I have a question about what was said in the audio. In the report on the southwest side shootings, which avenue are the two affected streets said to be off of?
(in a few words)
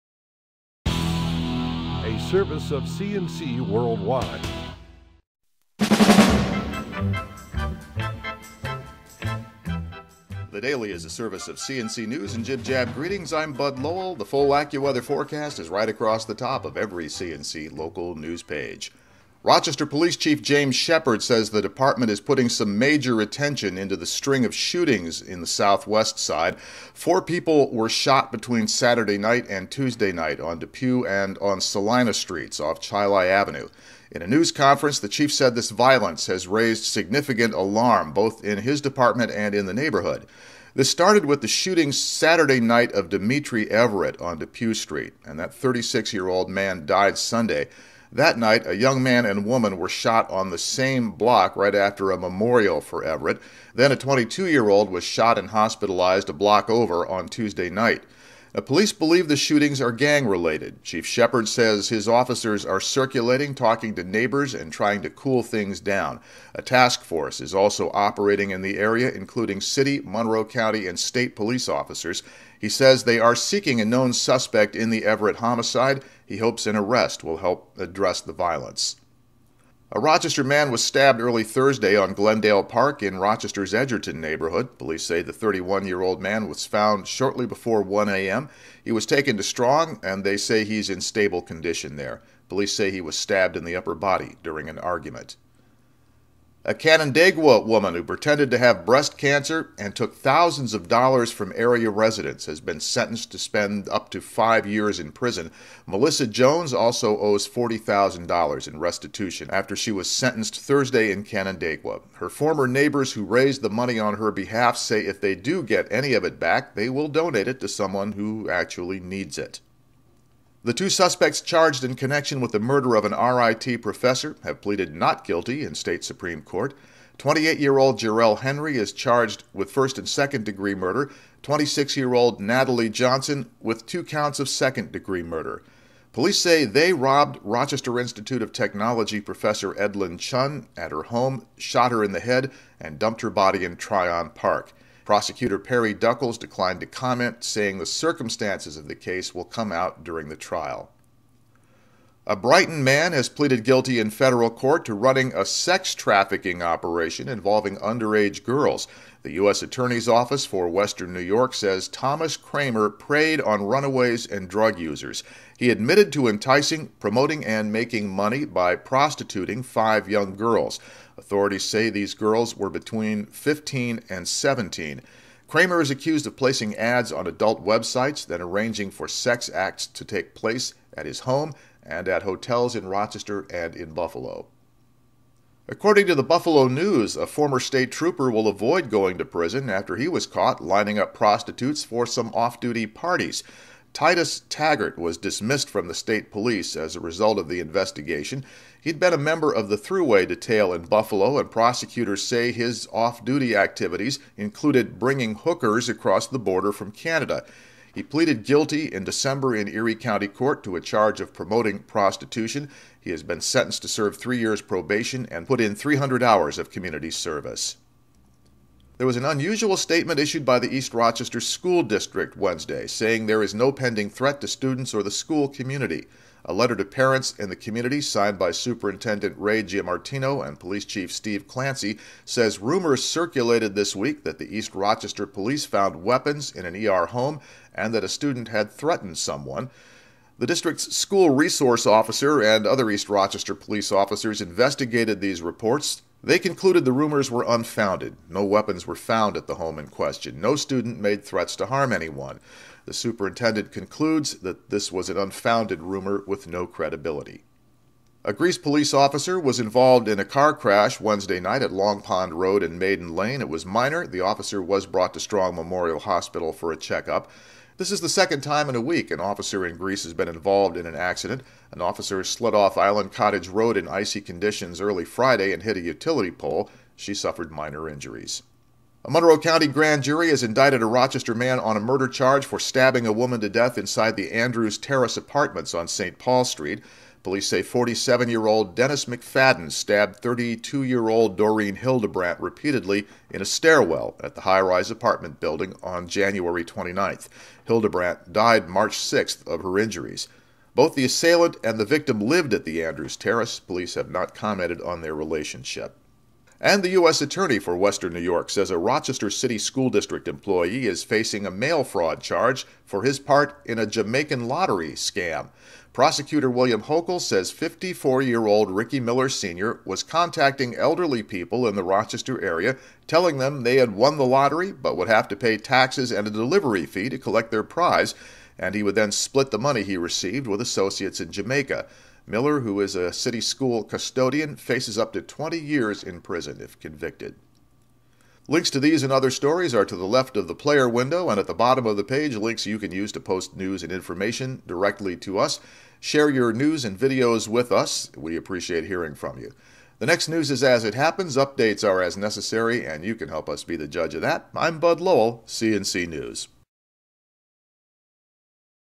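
Chili Avenue.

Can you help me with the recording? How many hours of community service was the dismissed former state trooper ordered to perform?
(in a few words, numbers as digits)
300.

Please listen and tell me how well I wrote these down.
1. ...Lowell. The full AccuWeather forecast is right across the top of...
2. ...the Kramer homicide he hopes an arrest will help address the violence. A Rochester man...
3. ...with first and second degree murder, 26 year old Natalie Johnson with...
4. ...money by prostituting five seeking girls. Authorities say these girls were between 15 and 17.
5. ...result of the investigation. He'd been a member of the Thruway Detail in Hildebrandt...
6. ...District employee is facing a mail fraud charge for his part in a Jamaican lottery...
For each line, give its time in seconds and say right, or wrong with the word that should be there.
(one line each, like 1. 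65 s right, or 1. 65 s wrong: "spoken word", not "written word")
1. 13 s right
2. 74 s wrong: "Everett", not "Kramer"
3. 129 s right
4. 168 s wrong: "young", not "seeking"
5. 197 s wrong: "Buffalo", not "Hildebrandt"
6. 309 s right.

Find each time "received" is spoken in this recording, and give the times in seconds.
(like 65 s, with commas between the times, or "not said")
329 s.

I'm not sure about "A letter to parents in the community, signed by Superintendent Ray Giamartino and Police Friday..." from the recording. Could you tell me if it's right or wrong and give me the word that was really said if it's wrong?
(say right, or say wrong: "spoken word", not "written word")
wrong: "Chief", not "Friday".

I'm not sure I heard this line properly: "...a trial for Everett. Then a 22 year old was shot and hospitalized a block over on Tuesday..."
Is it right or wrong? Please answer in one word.
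wrong.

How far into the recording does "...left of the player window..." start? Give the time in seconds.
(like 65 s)
340 s.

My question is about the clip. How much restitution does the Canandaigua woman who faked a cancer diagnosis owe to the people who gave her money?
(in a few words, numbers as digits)
$40,000.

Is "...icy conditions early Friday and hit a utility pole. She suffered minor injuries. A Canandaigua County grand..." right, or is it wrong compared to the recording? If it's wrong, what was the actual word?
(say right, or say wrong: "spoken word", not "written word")
wrong: "Monroe", not "Canandaigua".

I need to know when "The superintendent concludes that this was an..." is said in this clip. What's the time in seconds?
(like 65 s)
252 s.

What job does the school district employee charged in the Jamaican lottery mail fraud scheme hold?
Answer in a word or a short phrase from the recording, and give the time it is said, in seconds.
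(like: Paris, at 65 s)
city school custodian, at 333 s.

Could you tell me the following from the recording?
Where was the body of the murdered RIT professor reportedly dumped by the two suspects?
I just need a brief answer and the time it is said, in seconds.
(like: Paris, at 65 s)
Tryon Park, at 143 s.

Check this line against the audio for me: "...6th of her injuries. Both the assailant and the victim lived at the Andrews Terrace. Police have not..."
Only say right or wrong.
right.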